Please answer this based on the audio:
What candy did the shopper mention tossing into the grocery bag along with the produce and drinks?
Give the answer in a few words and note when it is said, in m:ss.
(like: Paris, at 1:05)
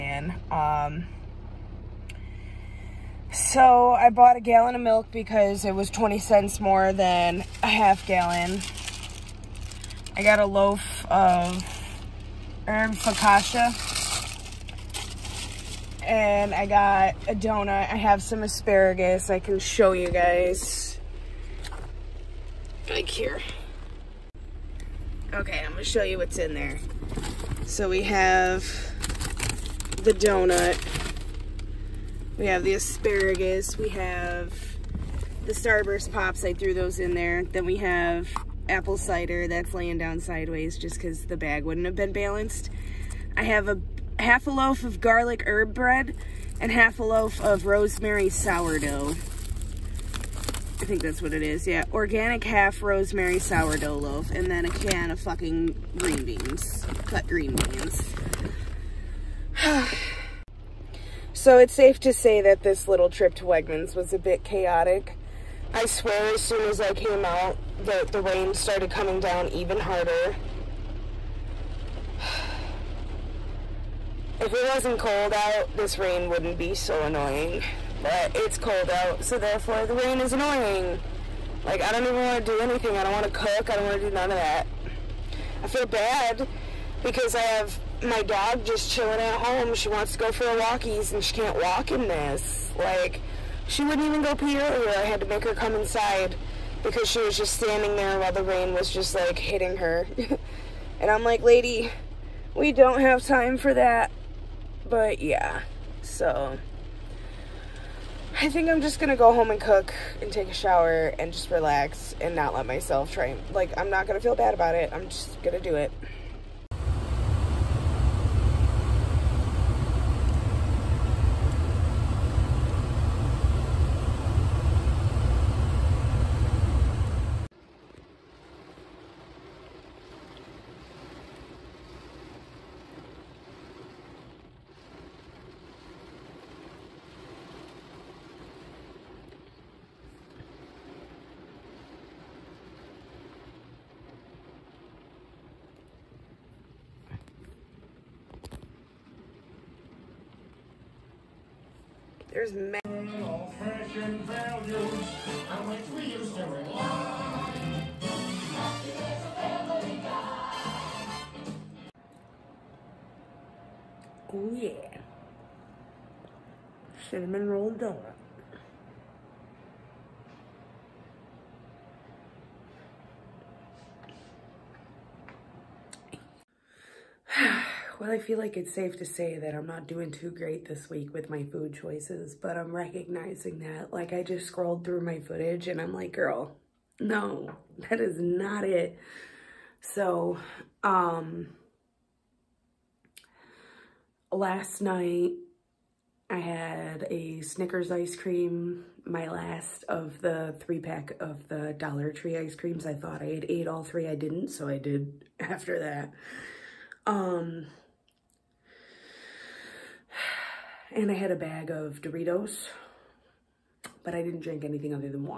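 Starburst Pops, at 0:35.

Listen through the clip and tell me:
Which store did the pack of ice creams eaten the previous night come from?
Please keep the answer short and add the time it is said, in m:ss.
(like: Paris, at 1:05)
Dollar Tree, at 3:21.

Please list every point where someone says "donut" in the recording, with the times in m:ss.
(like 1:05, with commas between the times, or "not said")
0:17, 0:30.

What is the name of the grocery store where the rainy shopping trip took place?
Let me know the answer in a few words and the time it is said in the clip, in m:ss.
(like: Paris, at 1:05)
Wegmans, at 1:03.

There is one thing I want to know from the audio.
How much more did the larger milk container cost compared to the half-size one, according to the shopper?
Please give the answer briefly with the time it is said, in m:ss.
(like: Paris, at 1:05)
20 cents, at 0:05.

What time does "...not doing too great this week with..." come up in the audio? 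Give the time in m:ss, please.
2:59.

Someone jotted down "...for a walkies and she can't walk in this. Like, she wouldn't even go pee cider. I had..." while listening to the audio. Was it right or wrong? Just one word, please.
wrong.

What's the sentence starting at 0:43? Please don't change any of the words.
I have a half a loaf of garlic herb bread and half a loaf of rosemary sourdough.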